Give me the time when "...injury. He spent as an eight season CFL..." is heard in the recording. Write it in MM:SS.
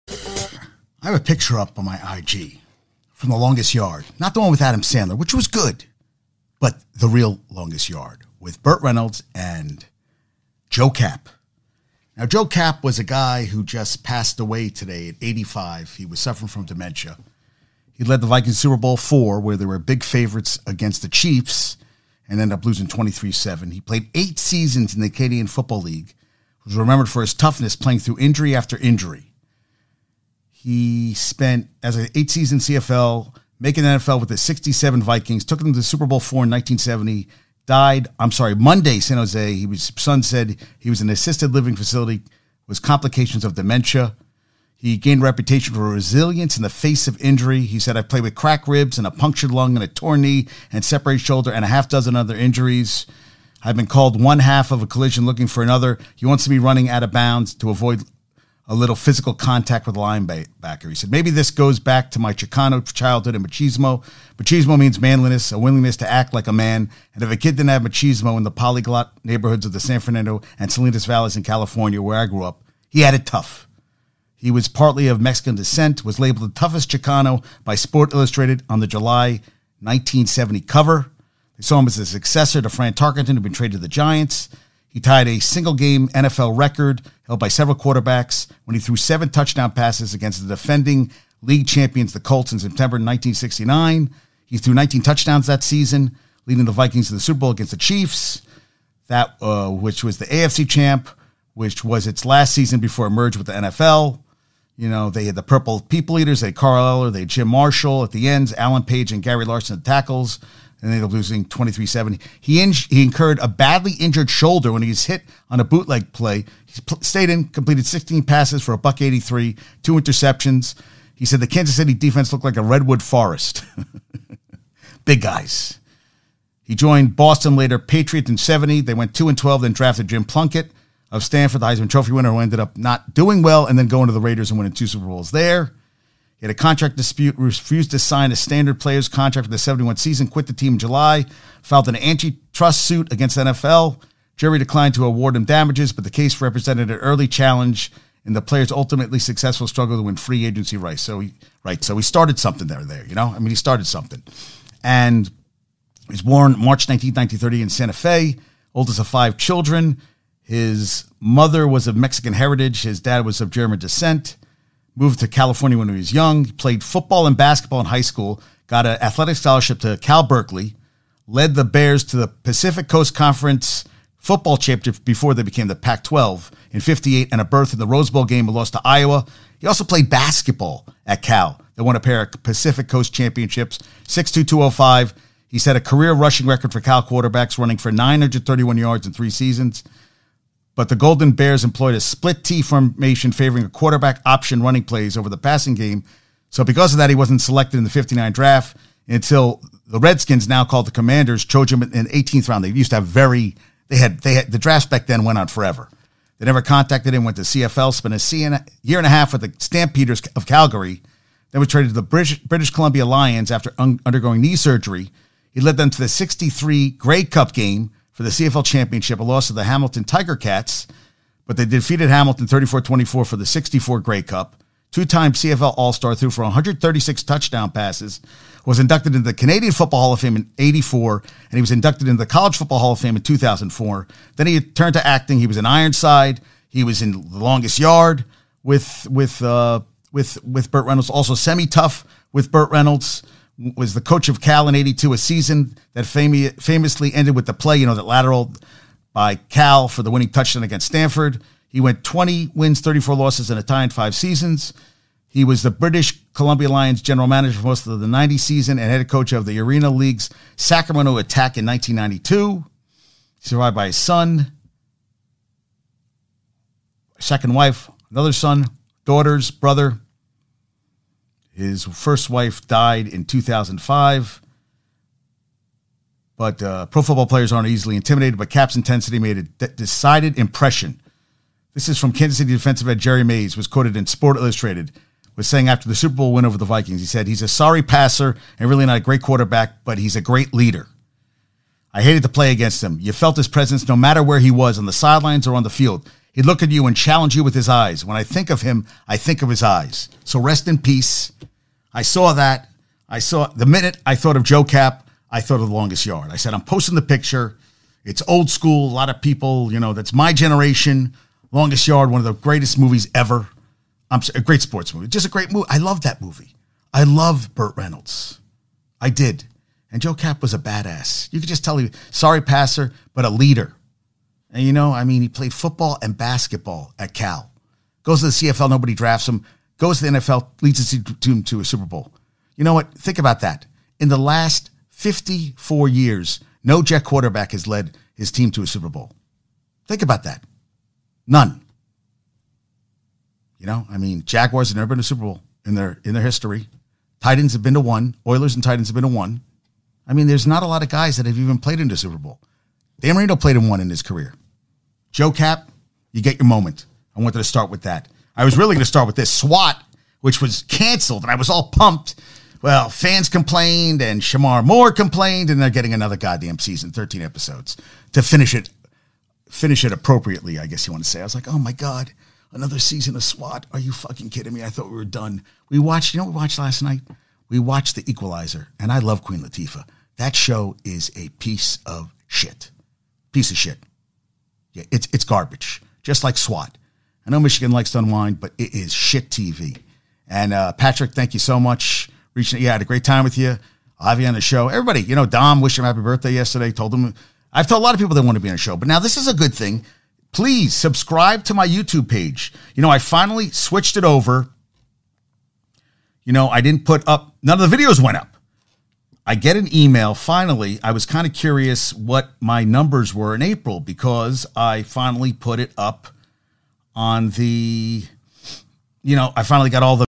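00:28.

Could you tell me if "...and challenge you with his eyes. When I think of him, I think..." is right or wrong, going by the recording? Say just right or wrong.
right.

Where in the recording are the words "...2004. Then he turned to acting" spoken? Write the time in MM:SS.
03:53.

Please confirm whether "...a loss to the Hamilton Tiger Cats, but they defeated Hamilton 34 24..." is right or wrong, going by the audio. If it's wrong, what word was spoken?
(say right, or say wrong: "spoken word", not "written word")
right.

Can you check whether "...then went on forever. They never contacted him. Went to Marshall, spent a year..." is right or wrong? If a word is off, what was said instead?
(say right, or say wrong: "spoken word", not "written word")
wrong: "CFL", not "Marshall".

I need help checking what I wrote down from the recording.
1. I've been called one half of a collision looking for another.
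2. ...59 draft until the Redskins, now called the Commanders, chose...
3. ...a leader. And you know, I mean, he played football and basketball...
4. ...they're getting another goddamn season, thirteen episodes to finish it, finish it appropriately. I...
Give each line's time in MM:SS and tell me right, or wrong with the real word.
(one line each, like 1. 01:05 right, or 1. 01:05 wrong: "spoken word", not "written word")
1. 00:53 right
2. 03:17 right
3. 05:23 right
4. 06:05 right.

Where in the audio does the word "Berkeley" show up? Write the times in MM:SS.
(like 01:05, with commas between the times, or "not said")
02:50.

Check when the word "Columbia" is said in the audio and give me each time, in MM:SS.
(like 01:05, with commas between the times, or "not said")
03:32, 04:16.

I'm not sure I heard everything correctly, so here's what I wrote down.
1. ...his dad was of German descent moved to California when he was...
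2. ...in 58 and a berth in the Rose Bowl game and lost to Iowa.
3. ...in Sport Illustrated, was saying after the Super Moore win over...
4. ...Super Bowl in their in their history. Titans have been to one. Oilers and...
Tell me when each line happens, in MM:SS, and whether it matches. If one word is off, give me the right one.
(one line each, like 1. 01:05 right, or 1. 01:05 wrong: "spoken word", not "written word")
1. 02:42 right
2. 02:56 right
3. 04:43 wrong: "Bowl", not "Moore"
4. 05:45 right.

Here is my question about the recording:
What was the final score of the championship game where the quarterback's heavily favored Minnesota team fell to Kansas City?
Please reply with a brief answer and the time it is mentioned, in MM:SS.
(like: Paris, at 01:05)
23-7, at 00:22.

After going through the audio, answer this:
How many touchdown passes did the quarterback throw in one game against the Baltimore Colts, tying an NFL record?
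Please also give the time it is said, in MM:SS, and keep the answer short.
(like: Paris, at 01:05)
7, at 01:28.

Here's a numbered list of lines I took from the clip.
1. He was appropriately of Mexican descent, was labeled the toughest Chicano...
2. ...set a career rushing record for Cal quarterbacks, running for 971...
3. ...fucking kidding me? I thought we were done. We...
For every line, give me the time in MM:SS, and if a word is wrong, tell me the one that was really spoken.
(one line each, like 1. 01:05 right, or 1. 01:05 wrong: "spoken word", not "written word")
1. 01:14 wrong: "partly", not "appropriately"
2. 03:05 wrong: "931", not "971"
3. 06:13 right.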